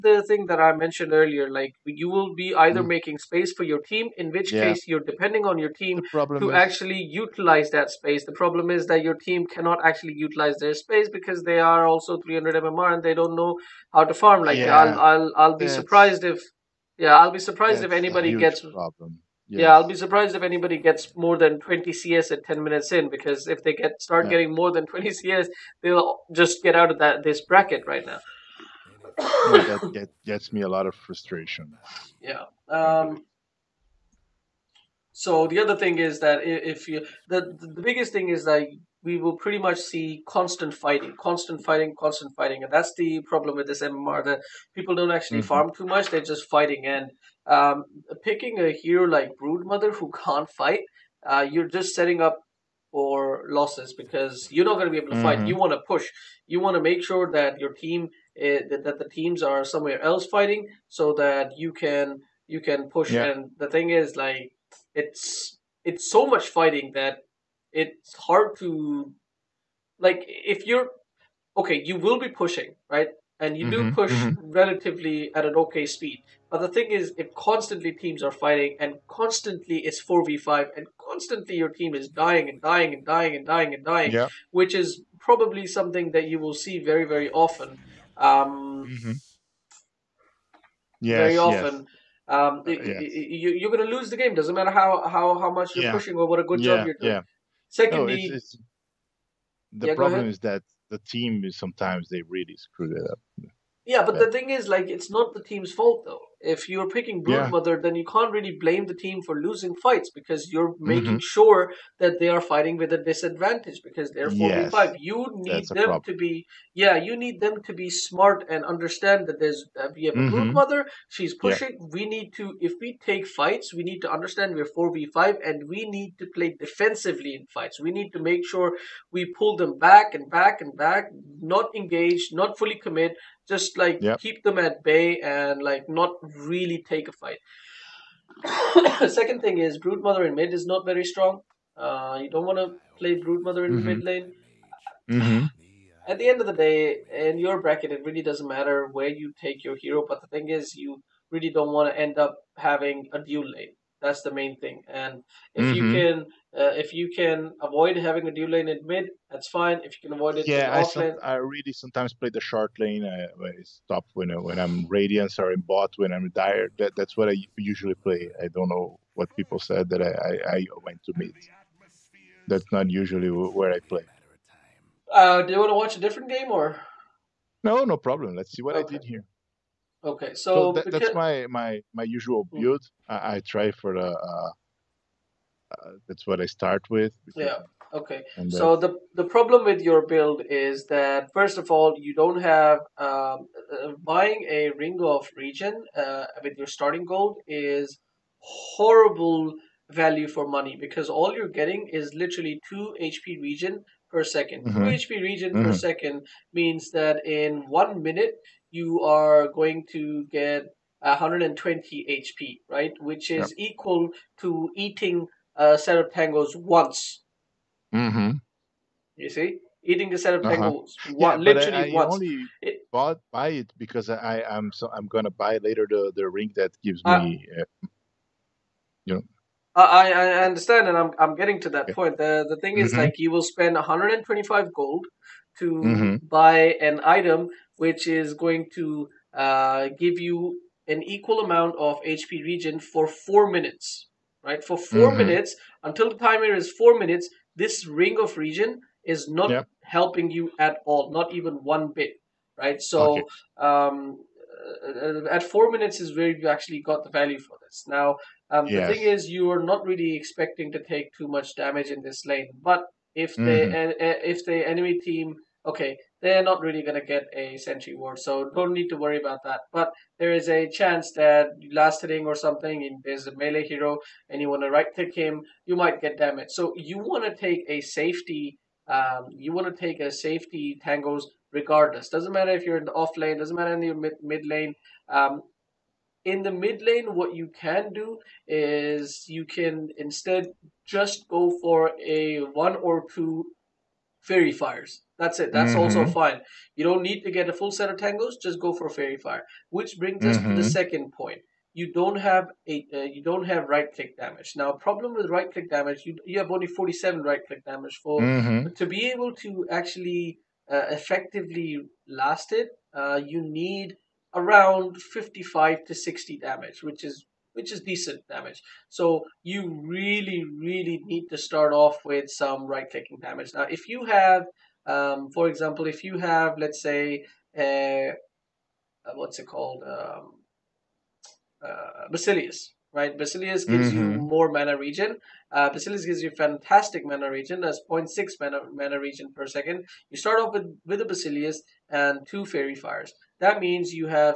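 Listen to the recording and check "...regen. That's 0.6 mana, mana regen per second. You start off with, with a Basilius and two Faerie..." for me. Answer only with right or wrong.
right.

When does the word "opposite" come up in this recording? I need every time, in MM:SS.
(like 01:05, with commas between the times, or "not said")
not said.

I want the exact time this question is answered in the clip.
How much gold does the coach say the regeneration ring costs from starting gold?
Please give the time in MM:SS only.
03:53.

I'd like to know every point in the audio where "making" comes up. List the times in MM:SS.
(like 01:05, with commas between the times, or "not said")
00:02, 01:50.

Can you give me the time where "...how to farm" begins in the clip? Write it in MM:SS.
00:13.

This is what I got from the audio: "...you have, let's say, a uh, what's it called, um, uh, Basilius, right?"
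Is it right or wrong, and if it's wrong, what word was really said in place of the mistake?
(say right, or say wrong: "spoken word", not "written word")
right.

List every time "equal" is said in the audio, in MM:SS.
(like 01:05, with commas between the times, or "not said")
03:33, 04:01.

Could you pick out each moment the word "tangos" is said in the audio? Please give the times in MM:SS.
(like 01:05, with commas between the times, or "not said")
03:36, 03:40, 04:40, 04:57.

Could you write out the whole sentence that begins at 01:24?
which is probably something that you will see very, very often.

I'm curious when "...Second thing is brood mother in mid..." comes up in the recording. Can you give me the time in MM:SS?
02:19.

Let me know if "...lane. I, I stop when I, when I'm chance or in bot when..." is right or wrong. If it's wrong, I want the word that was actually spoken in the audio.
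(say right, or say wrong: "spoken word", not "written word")
wrong: "radiance", not "chance".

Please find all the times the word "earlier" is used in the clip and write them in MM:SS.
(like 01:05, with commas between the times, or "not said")
00:01.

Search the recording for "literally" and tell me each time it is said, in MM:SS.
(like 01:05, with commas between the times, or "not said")
03:22, 03:41.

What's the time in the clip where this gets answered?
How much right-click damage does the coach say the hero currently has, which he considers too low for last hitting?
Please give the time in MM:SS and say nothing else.
05:06.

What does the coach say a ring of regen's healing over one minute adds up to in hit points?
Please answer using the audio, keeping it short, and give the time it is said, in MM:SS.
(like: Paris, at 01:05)
120, at 03:31.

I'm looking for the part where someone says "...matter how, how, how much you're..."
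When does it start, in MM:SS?
01:34.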